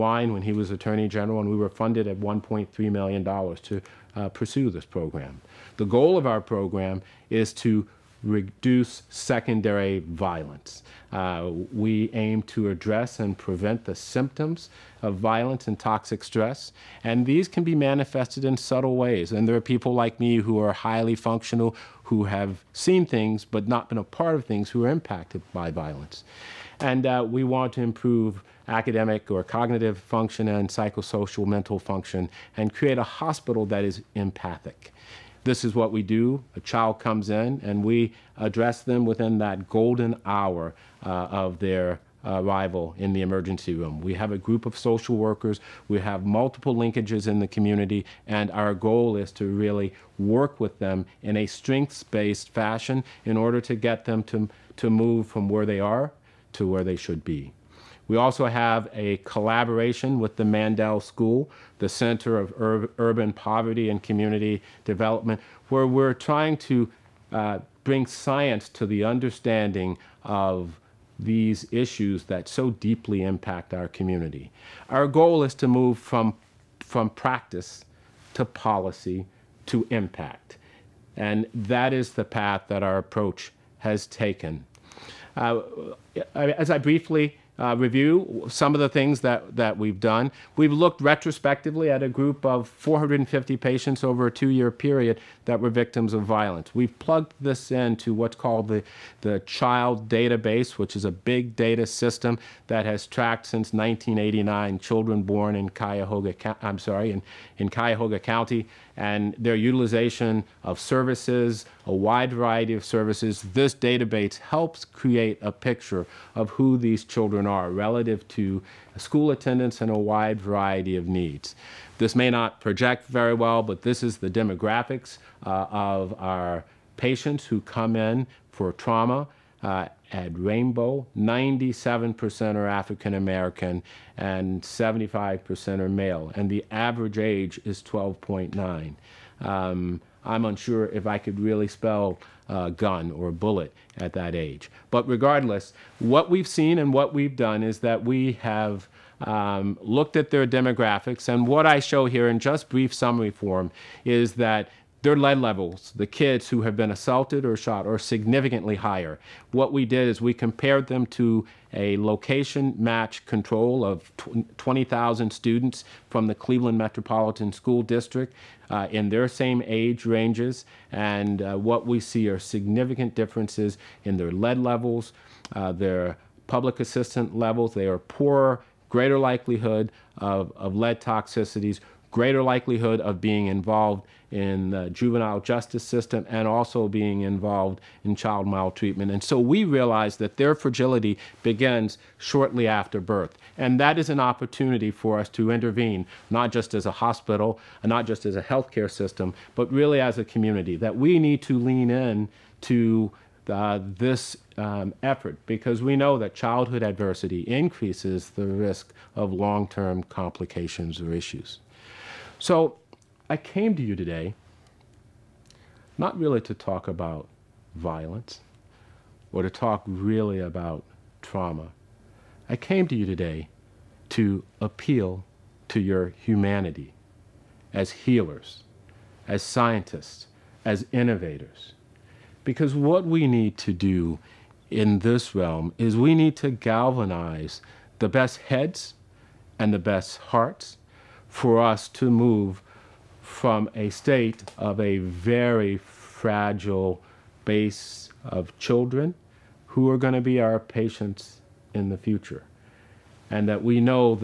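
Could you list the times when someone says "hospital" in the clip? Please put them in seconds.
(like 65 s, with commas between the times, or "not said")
33 s, 196 s.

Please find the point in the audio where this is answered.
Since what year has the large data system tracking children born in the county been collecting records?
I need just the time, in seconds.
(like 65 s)
103 s.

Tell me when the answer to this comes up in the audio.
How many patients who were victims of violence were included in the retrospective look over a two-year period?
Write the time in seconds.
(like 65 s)
92 s.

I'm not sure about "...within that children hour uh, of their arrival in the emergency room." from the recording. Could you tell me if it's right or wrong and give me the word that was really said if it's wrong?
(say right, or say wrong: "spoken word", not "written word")
wrong: "golden", not "children".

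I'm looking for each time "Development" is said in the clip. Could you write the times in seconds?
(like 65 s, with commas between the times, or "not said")
64 s.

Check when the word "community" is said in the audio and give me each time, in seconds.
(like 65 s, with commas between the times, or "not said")
47 s, 64 s, 73 s, 200 s.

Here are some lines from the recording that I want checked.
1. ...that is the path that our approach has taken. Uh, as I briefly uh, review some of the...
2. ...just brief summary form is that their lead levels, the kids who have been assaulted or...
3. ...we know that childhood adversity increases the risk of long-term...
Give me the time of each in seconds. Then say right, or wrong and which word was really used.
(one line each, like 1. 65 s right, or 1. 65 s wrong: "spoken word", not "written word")
1. 81 s right
2. 152 s right
3. 205 s right.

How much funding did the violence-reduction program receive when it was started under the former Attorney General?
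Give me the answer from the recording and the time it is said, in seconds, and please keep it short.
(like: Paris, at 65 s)
$1.3 million, at 2 s.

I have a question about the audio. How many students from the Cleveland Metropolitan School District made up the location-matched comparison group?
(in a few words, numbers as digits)
20,000.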